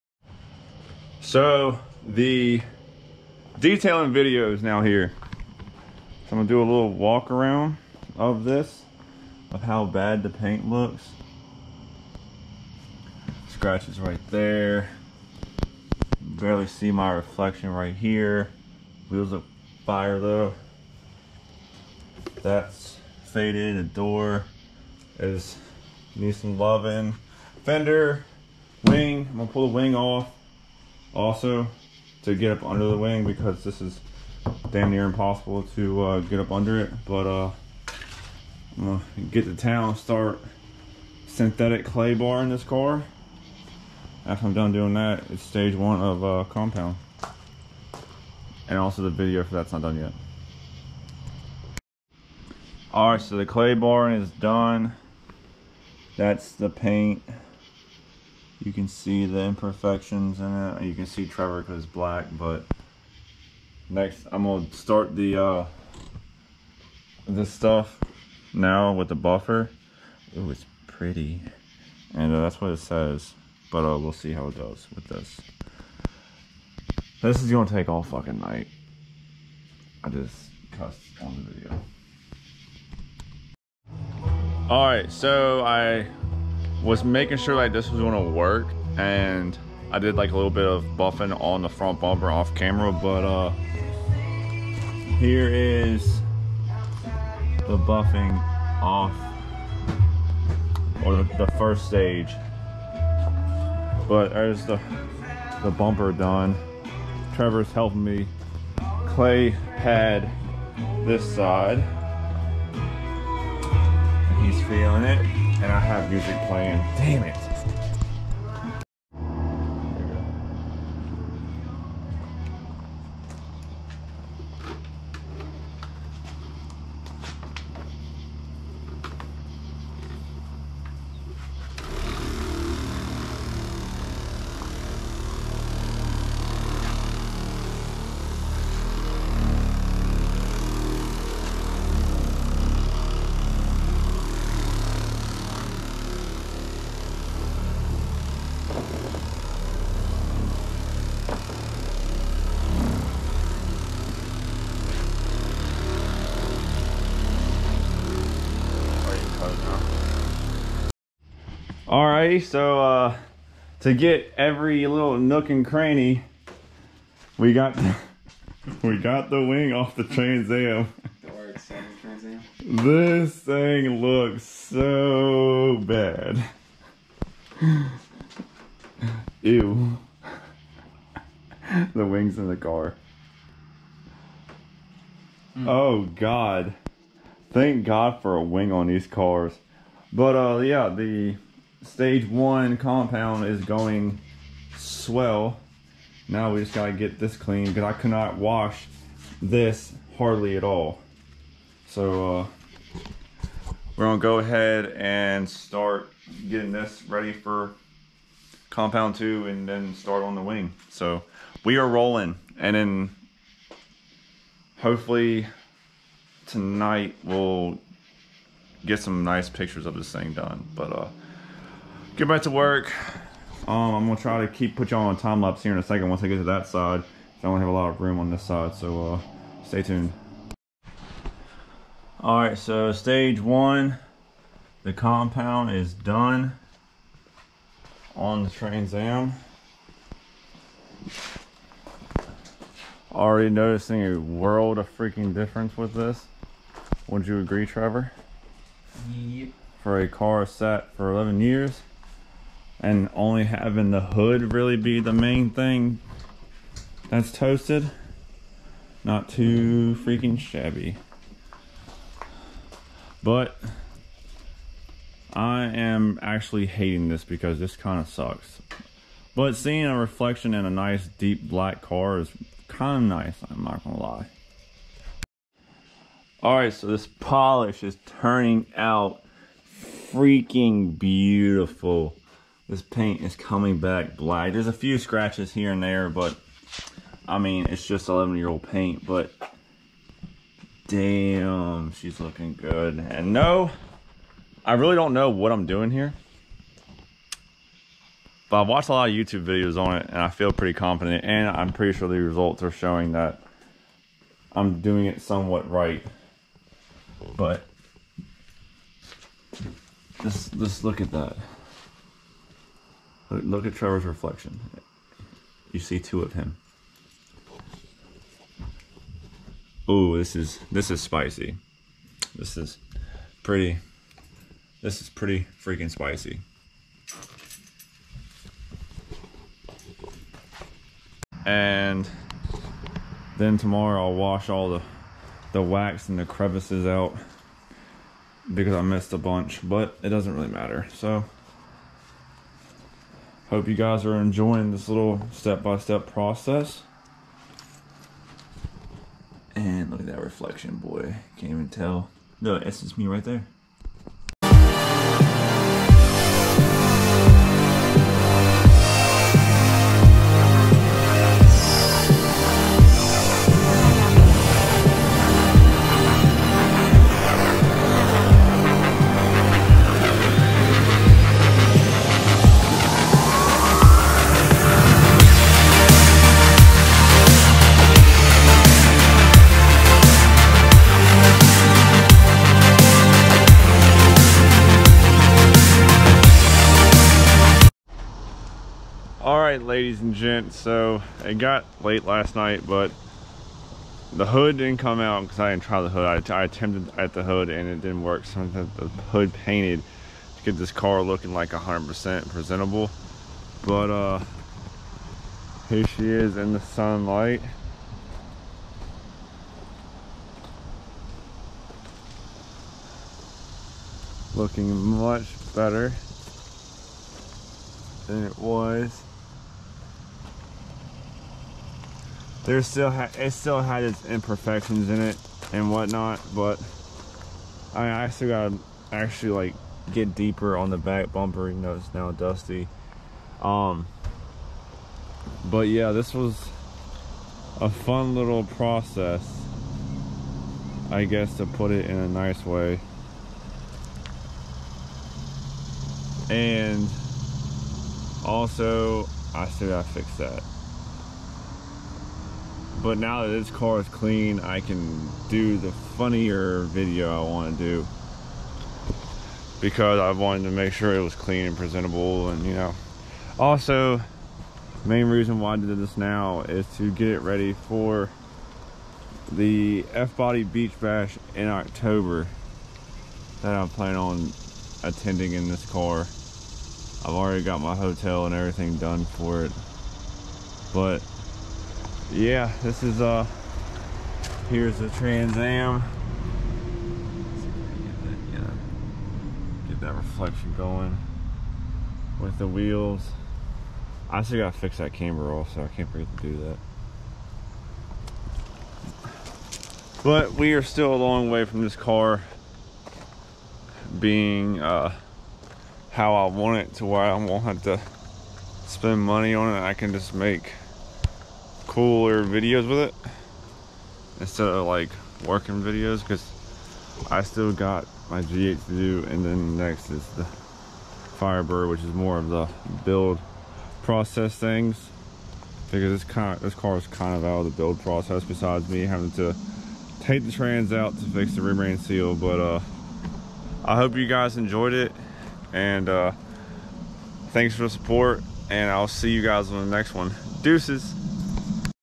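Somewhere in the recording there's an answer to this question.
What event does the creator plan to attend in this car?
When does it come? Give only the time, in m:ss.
7:49.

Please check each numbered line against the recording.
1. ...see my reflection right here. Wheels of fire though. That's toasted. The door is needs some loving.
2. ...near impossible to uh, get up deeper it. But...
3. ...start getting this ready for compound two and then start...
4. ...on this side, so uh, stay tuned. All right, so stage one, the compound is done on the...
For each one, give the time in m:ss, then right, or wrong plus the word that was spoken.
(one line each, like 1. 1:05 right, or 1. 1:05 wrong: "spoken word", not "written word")
1. 0:16 wrong: "faded", not "toasted"
2. 0:34 wrong: "under", not "deeper"
3. 3:25 right
4. 3:48 right.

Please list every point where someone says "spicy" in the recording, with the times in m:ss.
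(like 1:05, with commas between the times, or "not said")
5:20, 5:25.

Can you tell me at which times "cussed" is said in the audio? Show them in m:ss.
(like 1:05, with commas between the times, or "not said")
1:20.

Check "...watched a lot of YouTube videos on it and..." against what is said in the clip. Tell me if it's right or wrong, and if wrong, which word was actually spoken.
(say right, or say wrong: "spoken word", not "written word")
right.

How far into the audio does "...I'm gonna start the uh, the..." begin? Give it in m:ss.
1:04.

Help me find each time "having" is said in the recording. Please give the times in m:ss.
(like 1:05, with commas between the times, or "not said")
4:13, 8:48.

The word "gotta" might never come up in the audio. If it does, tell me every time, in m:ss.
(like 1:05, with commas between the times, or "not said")
3:16, 7:08, 7:29, 8:14.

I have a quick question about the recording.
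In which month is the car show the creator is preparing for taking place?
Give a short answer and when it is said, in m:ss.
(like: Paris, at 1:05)
October, at 7:51.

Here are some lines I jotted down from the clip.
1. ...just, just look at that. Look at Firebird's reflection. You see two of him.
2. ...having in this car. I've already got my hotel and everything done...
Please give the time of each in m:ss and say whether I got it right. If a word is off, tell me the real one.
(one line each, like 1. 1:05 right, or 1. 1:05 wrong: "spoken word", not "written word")
1. 5:10 wrong: "Trevor", not "Firebird"
2. 7:54 wrong: "attending", not "having".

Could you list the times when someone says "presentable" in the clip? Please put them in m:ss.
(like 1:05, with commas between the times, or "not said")
6:42, 7:41.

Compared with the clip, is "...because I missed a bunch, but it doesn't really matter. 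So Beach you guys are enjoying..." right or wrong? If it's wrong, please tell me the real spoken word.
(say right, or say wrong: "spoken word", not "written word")
wrong: "Hope", not "Beach".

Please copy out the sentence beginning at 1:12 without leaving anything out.
And uh, that's what it says.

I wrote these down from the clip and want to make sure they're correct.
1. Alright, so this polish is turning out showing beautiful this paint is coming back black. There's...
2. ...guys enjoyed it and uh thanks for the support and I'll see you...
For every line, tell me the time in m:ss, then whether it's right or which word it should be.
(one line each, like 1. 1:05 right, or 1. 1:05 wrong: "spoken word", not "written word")
1. 4:36 wrong: "freaking", not "showing"
2. 8:54 right.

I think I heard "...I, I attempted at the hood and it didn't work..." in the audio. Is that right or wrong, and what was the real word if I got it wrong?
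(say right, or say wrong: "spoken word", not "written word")
right.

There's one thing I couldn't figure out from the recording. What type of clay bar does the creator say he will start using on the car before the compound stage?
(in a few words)
Synthetic.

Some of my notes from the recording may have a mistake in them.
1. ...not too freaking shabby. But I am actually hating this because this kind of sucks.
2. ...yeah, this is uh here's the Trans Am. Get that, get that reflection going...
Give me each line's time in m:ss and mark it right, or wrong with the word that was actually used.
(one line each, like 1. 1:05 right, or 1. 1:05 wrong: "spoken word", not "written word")
1. 4:19 right
2. 8:02 right.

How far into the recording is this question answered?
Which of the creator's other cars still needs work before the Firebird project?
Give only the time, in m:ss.
8:38.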